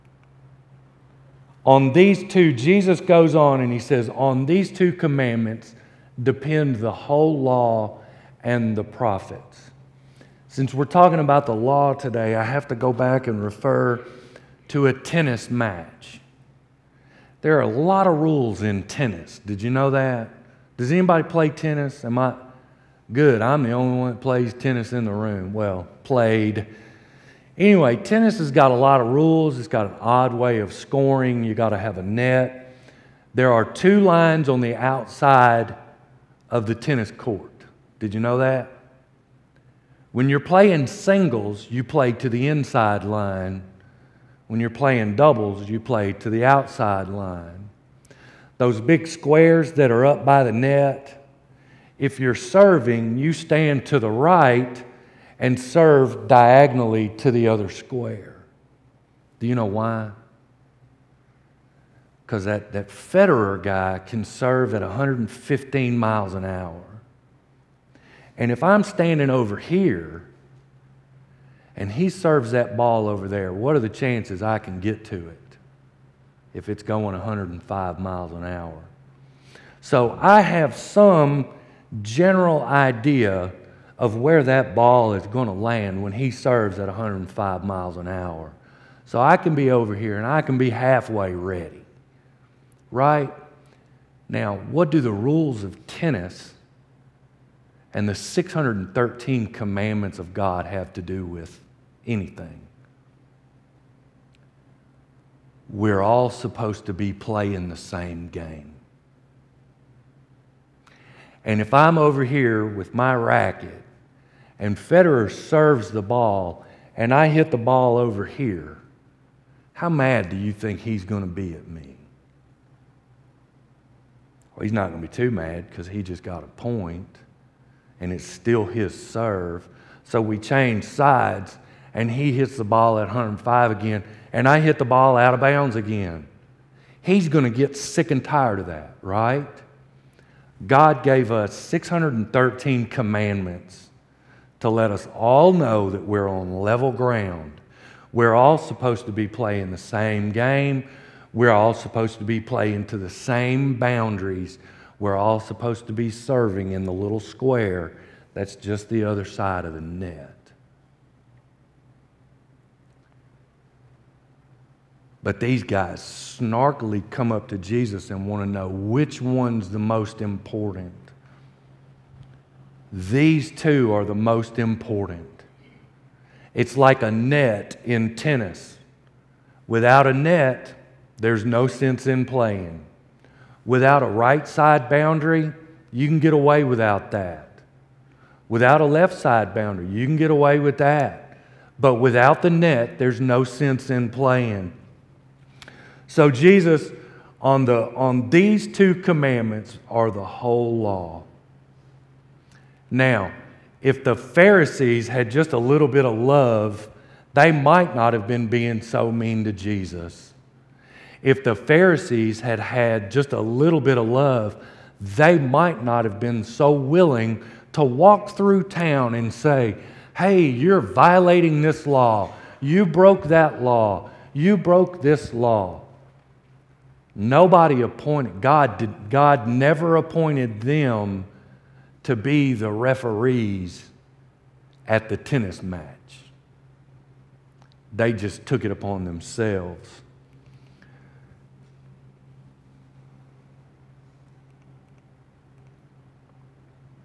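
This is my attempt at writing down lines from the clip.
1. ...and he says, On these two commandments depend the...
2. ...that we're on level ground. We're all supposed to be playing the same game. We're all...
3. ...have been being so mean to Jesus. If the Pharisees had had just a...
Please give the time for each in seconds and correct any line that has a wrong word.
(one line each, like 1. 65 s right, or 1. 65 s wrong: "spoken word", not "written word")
1. 3 s right
2. 145 s right
3. 208 s right.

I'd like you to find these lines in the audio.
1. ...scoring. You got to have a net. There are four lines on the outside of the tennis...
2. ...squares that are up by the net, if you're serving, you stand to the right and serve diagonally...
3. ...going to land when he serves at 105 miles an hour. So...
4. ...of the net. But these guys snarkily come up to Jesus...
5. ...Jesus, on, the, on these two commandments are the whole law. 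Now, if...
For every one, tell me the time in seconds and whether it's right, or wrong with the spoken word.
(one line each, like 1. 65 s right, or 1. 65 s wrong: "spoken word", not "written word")
1. 30 s wrong: "two", not "four"
2. 49 s right
3. 85 s right
4. 159 s right
5. 196 s right.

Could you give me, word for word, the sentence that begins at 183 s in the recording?
Without a right side boundary, you can get away without that.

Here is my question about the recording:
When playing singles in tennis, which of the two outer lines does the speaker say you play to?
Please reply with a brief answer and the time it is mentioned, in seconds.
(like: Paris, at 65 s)
the inside line, at 42 s.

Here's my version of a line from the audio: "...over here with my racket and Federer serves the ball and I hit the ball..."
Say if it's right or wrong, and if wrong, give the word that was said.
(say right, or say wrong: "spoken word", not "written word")
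right.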